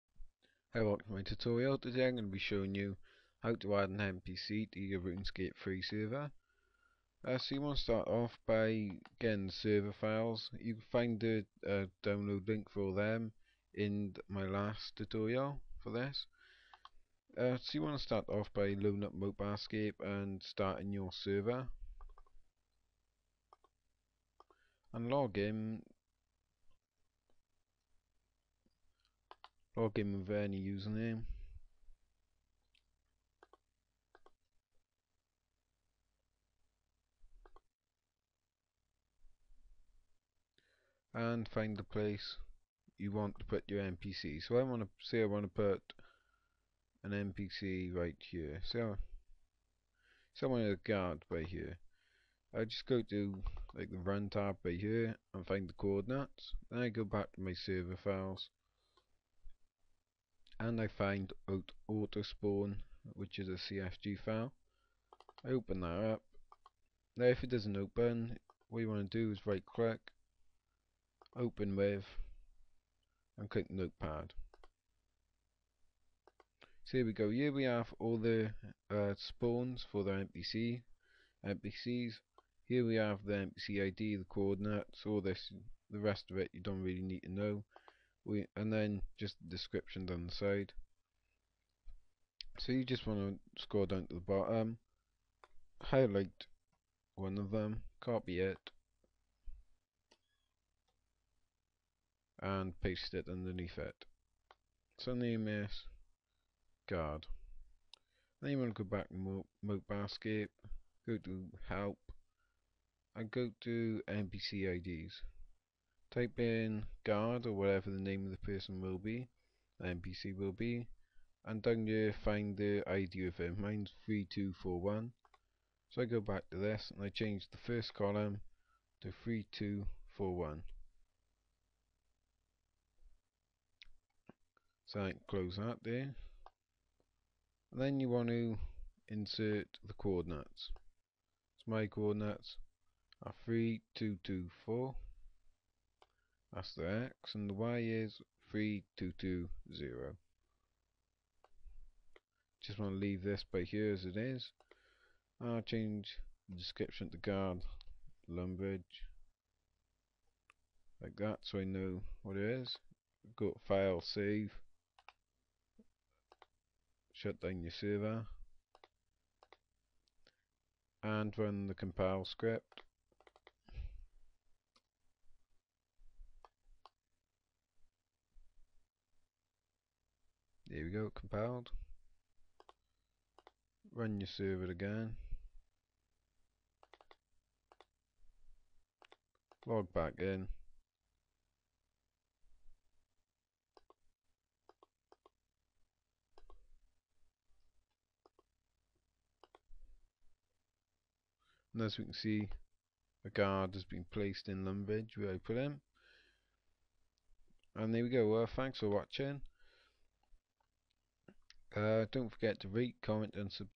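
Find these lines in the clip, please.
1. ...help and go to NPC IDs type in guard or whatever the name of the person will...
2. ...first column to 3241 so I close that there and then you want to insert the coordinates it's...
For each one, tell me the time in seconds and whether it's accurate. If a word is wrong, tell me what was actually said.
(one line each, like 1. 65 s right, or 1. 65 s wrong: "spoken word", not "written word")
1. 111 s right
2. 127 s right.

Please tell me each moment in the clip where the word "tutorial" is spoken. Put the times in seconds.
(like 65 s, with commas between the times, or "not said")
1 s, 14 s.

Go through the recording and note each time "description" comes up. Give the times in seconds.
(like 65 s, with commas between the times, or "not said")
89 s, 156 s.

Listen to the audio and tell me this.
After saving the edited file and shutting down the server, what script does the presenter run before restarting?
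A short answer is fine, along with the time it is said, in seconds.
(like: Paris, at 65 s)
compile script, at 171 s.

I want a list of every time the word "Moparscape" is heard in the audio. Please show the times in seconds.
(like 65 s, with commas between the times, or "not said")
19 s, 109 s.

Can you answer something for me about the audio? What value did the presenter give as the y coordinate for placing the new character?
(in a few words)
3220.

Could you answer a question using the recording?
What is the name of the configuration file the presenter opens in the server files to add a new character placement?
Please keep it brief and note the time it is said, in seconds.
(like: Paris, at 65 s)
spawn, at 62 s.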